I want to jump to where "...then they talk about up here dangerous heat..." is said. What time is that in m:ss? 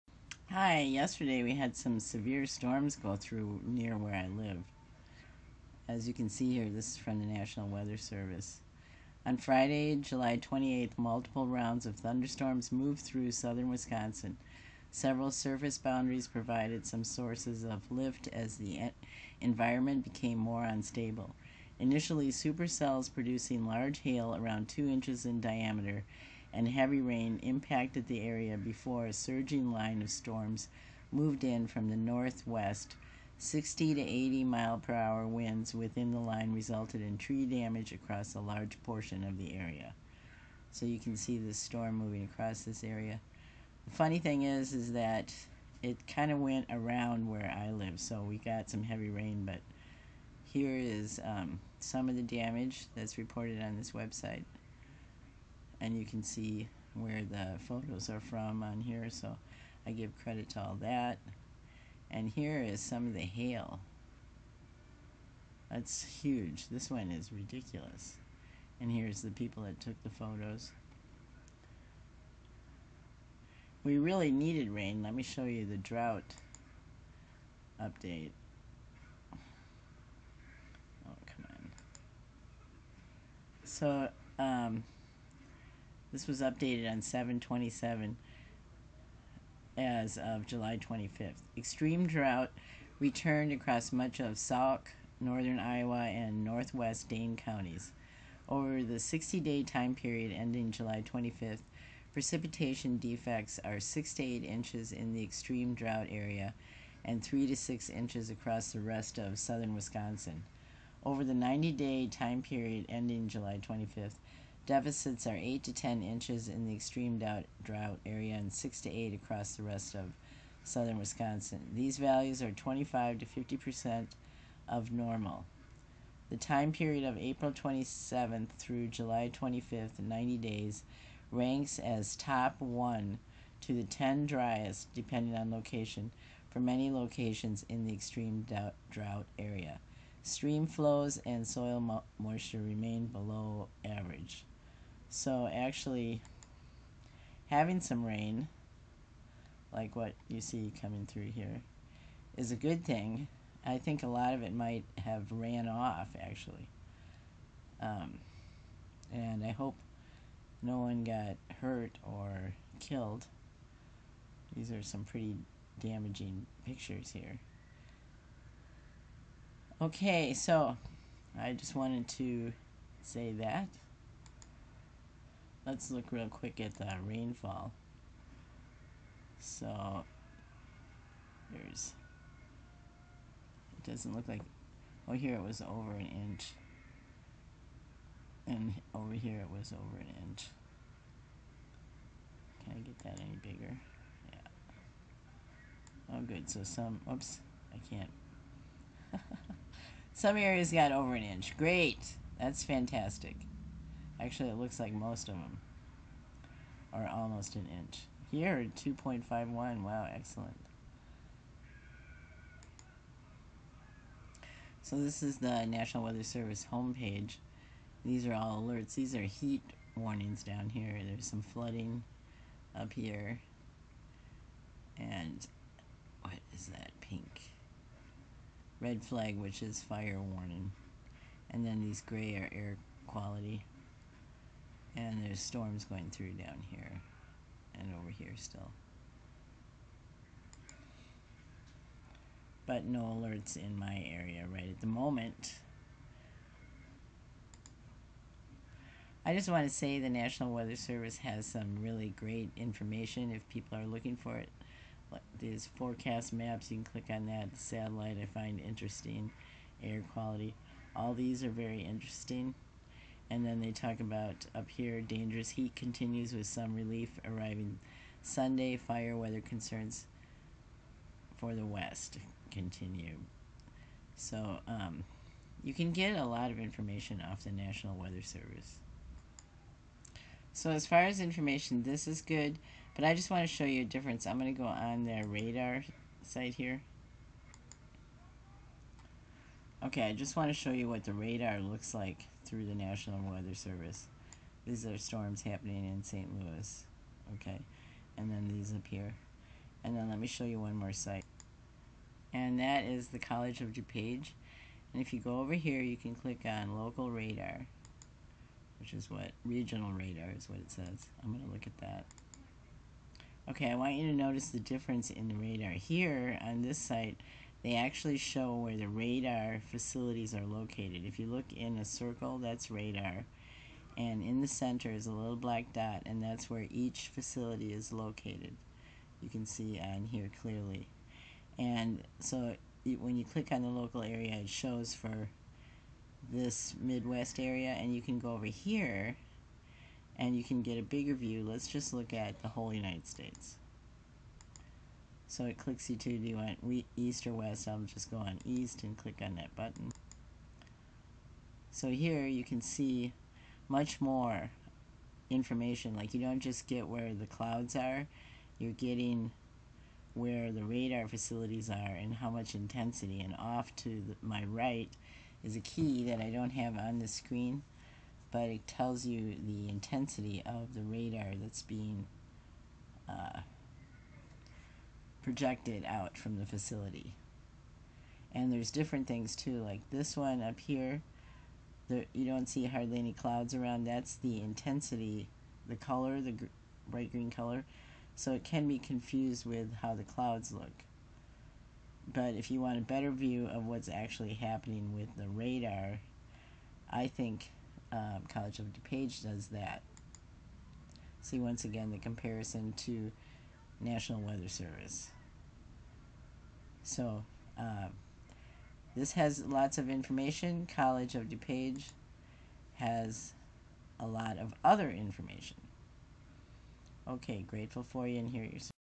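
4:23.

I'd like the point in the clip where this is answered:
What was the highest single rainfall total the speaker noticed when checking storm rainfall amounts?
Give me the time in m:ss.
3:28.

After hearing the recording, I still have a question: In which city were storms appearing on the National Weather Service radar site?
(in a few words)
St. Louis.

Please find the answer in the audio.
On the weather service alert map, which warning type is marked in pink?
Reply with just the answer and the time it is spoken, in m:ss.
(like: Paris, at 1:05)
Red flag, at 3:48.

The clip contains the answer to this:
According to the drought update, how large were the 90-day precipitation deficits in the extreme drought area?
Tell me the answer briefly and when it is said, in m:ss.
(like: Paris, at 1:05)
8 to 10 inches, at 1:55.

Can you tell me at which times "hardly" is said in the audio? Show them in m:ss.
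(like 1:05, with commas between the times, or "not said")
6:22.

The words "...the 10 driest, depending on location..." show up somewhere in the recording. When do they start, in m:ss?
2:13.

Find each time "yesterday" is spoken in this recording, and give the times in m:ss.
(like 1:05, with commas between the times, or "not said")
0:00.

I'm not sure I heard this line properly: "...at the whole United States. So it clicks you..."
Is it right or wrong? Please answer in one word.
right.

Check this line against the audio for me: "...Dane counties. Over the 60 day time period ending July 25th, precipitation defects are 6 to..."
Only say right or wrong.
right.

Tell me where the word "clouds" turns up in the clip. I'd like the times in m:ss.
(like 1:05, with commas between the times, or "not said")
5:57, 6:23, 6:30.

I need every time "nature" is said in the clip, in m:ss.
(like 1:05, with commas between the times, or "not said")
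not said.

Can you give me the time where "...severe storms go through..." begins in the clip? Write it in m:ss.
0:02.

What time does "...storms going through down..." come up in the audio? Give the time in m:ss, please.
3:55.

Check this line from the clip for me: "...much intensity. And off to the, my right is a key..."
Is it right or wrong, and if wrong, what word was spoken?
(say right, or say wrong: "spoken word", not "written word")
right.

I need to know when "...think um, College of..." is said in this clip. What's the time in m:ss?
6:37.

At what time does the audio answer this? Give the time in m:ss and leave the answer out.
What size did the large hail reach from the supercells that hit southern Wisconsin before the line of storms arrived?
0:24.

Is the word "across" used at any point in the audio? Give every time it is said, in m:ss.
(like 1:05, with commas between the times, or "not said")
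0:37, 0:42, 1:33, 1:48, 1:59.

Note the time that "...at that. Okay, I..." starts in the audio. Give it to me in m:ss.
5:11.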